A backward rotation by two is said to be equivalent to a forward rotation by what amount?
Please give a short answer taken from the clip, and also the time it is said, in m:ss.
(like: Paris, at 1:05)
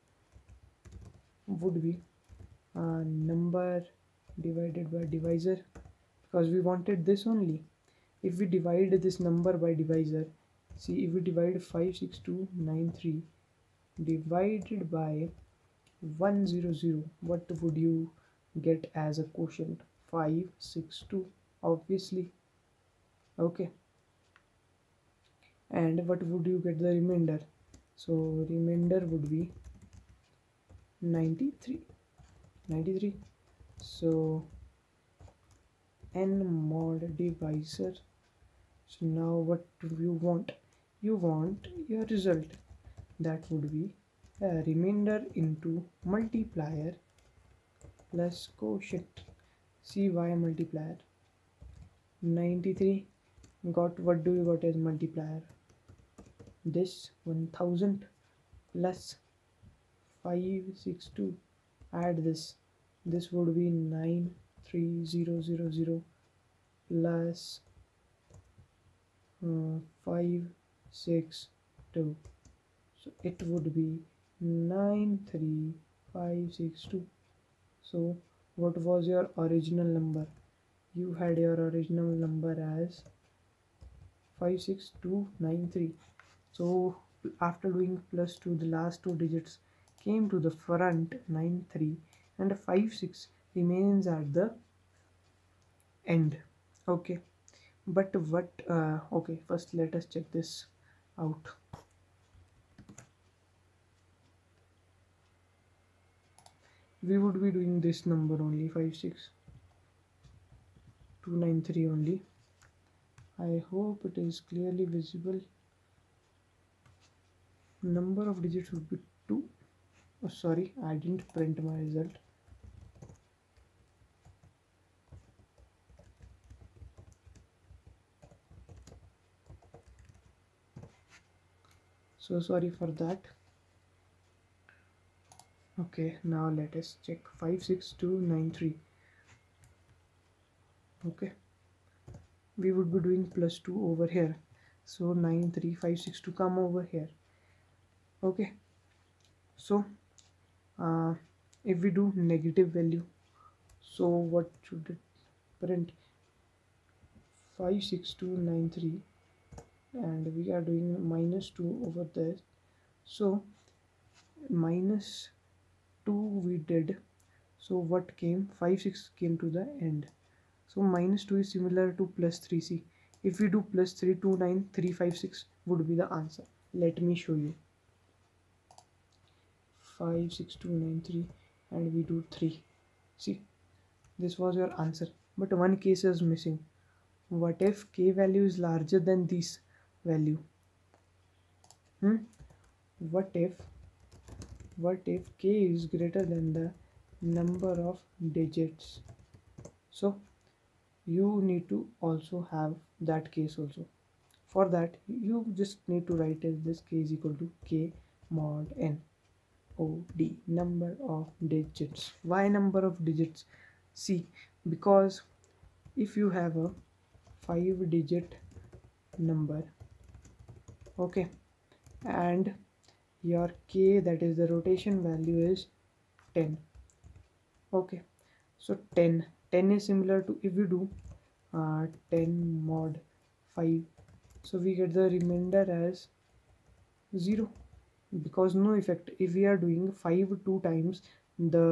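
3, at 2:52.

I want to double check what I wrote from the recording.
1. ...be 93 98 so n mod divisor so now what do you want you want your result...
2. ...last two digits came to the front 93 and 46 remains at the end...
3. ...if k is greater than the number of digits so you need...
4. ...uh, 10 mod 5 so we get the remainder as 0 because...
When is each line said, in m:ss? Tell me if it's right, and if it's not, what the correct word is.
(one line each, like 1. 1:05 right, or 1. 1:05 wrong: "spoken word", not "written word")
1. 0:29 wrong: "93", not "98"
2. 1:28 wrong: "56", not "46"
3. 3:15 right
4. 3:51 right.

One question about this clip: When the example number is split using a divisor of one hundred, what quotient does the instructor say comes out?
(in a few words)
562.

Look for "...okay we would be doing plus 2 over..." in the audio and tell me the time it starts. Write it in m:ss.
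2:21.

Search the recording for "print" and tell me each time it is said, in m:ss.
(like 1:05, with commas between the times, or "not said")
2:01, 2:35.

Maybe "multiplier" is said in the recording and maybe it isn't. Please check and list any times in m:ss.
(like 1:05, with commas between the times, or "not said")
0:46, 0:50, 0:54.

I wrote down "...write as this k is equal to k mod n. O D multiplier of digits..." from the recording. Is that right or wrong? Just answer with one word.
wrong.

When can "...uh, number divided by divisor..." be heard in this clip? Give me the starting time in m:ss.
0:02.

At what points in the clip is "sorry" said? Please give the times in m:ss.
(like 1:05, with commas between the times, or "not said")
2:00, 2:12.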